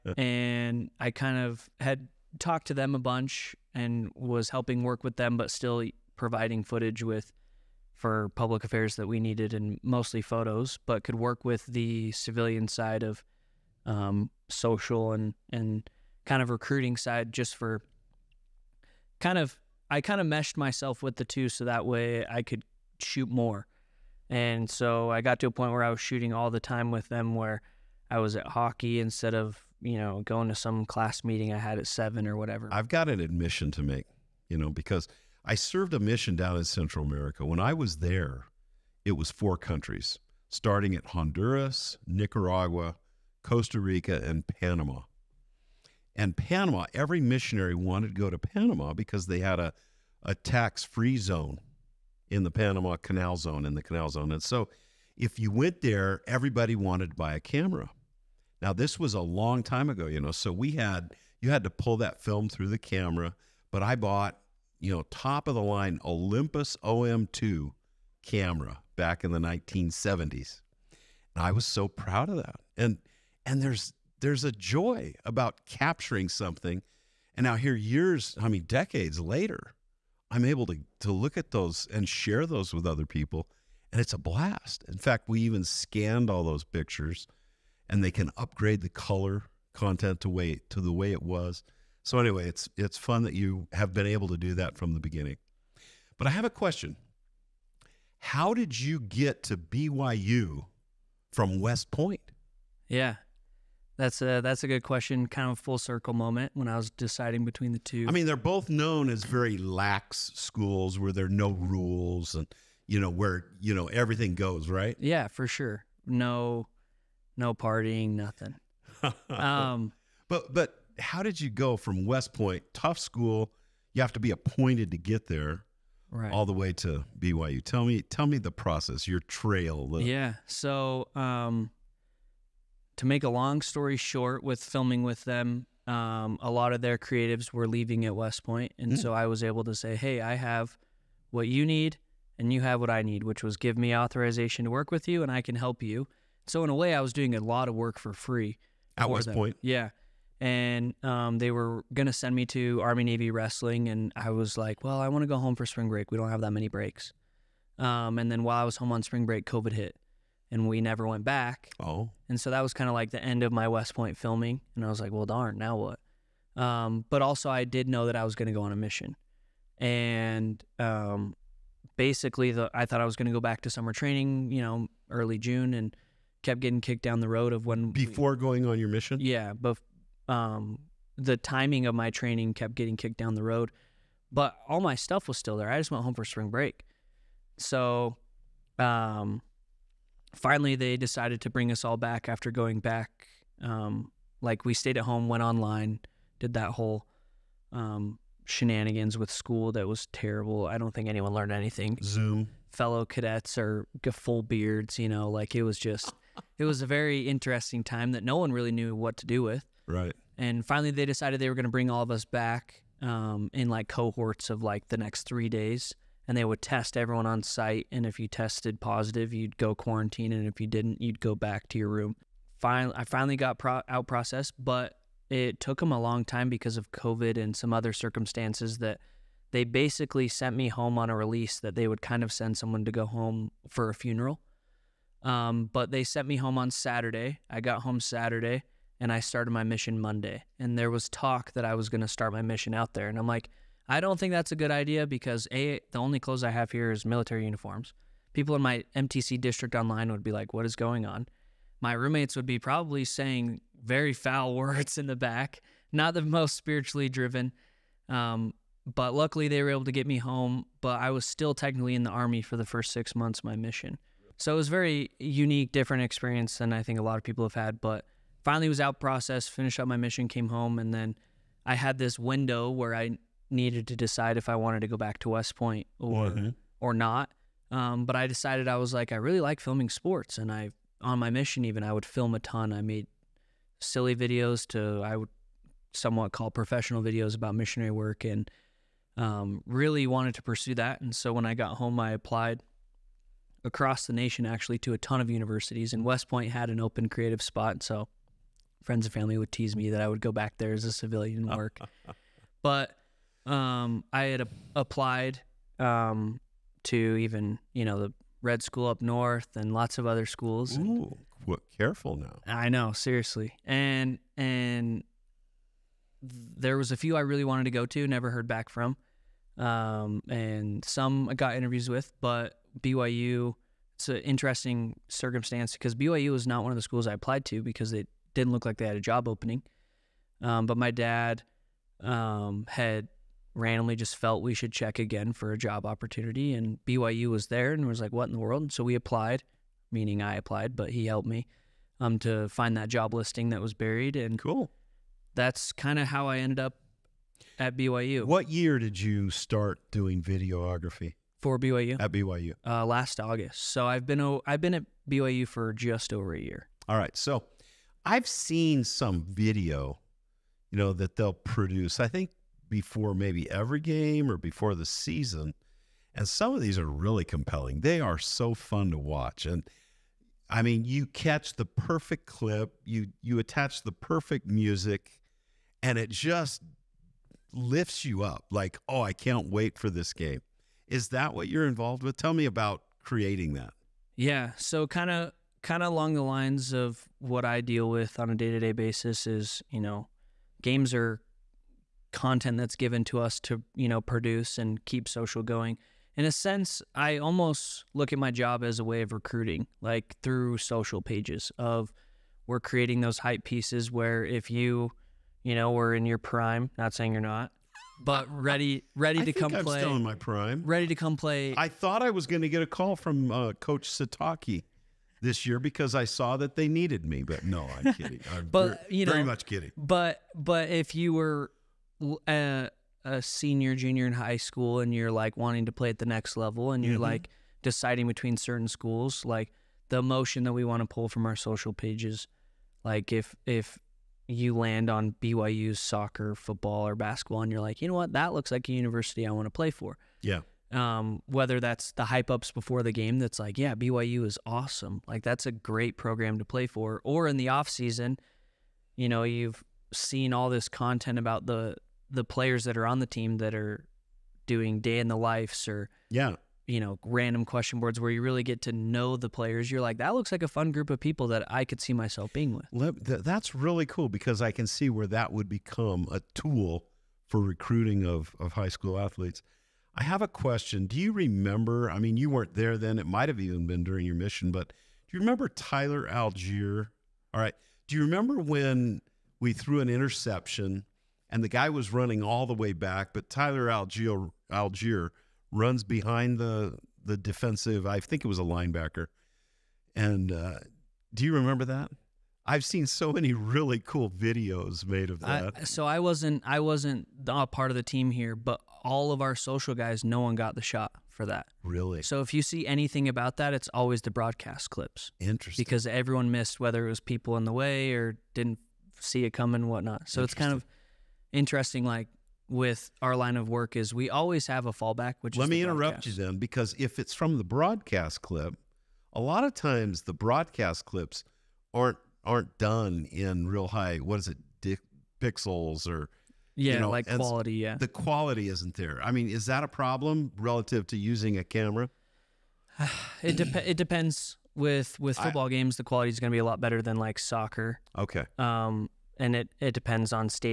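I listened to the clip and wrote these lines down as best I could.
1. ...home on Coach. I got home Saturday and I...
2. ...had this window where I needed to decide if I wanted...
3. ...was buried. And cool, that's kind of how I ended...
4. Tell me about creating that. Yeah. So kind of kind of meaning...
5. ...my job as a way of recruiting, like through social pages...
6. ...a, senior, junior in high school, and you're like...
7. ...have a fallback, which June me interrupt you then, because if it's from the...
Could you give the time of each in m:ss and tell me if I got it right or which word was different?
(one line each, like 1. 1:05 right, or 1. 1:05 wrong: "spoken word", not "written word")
1. 3:56 wrong: "Saturday", not "Coach"
2. 4:31 right
3. 5:43 right
4. 6:22 wrong: "along", not "meaning"
5. 6:38 right
6. 7:03 right
7. 8:34 wrong: "Let", not "June".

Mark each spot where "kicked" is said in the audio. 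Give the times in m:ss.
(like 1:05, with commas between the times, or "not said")
2:56, 3:02.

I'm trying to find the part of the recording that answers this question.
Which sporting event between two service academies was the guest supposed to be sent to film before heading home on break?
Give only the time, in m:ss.
2:32.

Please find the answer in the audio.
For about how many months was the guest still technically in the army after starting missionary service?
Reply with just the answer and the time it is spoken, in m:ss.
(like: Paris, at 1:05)
6, at 4:22.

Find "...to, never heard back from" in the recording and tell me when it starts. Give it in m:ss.
5:17.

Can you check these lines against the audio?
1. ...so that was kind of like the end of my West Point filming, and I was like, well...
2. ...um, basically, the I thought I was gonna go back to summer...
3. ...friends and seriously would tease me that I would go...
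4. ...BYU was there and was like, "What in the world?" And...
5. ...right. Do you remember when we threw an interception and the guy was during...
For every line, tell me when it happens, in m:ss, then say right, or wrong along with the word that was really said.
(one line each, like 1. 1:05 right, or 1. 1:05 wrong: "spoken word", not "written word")
1. 2:42 right
2. 2:50 right
3. 4:58 wrong: "family", not "seriously"
4. 5:36 right
5. 7:57 wrong: "running", not "during".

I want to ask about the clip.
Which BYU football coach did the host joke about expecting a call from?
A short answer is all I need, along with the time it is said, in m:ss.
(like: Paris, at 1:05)
Coach Sitake, at 6:53.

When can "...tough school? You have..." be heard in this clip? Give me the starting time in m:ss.
2:02.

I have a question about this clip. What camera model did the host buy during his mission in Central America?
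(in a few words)
Olympus OM2.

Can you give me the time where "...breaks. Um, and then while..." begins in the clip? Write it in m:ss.
2:36.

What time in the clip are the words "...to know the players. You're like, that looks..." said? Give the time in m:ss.
7:38.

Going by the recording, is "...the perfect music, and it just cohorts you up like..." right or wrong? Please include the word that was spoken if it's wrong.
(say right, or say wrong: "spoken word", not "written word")
wrong: "lifts", not "cohorts".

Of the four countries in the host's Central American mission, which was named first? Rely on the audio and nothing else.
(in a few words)
Honduras.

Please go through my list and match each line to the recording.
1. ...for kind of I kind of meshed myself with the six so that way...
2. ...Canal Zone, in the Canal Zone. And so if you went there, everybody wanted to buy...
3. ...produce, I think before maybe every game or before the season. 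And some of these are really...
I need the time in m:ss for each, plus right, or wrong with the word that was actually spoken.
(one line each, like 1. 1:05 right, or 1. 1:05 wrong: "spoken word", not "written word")
1. 0:17 wrong: "two", not "six"
2. 0:52 right
3. 6:01 right.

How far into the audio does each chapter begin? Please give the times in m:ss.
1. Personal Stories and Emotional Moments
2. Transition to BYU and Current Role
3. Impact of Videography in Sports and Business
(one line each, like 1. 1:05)
1. 7:55
2. 1:19
3. 5:04.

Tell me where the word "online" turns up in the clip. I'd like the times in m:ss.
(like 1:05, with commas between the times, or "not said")
3:15, 4:09.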